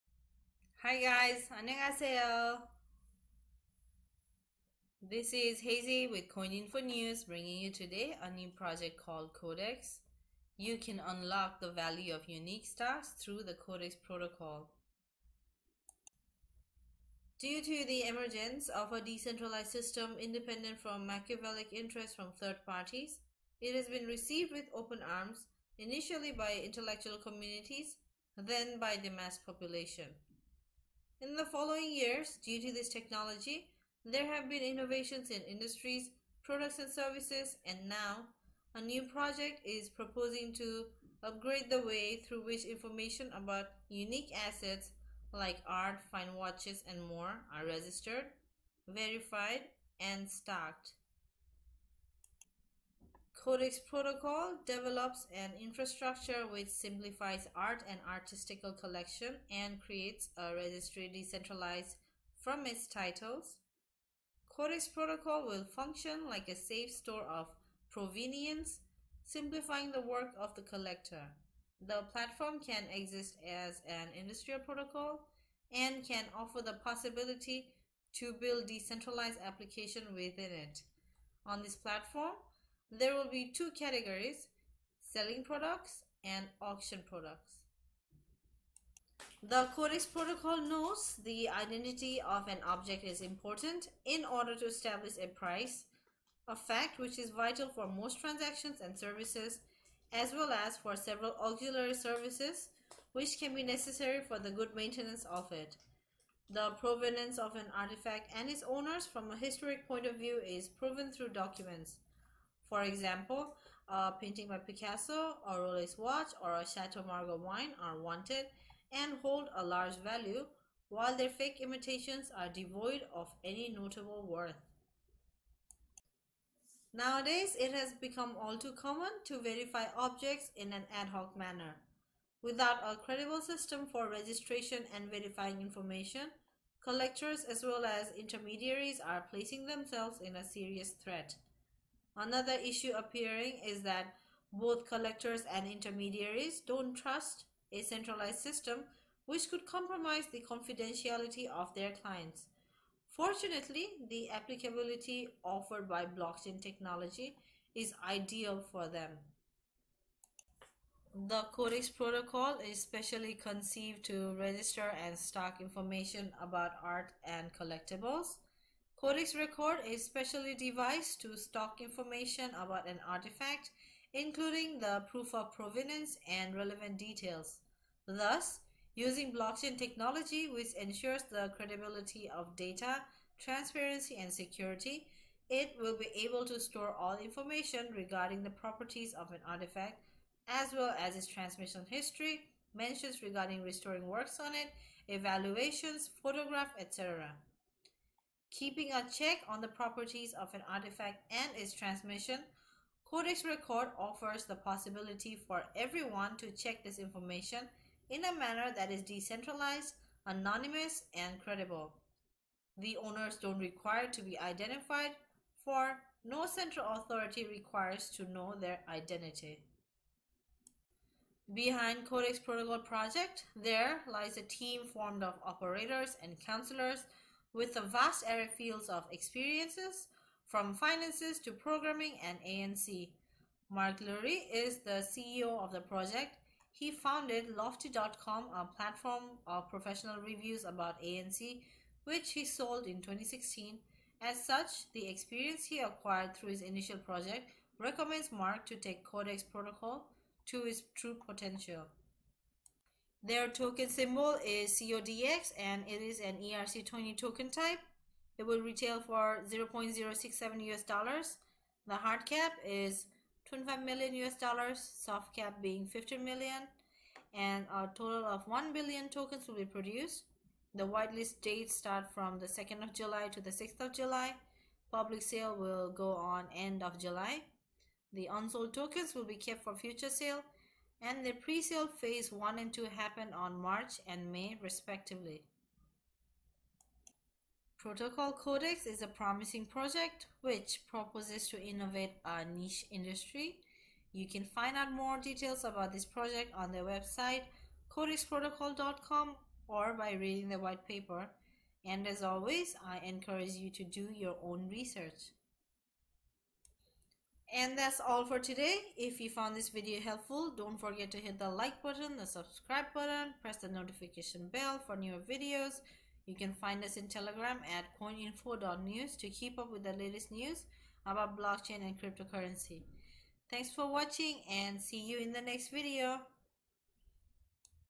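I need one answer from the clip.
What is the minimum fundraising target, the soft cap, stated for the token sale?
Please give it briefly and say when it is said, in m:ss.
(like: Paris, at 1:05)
15 million, at 4:25.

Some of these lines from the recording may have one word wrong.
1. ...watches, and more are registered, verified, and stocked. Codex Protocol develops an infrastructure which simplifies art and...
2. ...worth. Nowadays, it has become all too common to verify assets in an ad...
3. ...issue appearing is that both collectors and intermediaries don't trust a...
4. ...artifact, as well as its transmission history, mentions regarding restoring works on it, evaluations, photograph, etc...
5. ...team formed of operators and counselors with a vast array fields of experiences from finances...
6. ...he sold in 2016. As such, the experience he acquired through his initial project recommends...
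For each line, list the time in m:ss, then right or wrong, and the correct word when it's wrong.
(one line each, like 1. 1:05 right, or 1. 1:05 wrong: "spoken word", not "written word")
1. 0:46 right
2. 2:04 wrong: "objects", not "assets"
3. 2:22 right
4. 3:09 right
5. 3:44 right
6. 4:02 right.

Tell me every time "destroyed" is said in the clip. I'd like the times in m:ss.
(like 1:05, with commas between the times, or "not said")
not said.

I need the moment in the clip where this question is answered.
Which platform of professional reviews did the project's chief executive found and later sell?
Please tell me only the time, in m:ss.
3:57.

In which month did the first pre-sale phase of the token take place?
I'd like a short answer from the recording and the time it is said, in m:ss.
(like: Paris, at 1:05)
March, at 4:43.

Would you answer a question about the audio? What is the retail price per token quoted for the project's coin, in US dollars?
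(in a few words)
0.067.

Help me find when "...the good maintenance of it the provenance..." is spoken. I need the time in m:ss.
1:44.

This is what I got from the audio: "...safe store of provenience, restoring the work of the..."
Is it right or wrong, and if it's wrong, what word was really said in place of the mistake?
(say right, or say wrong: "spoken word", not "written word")
wrong: "simplifying", not "restoring".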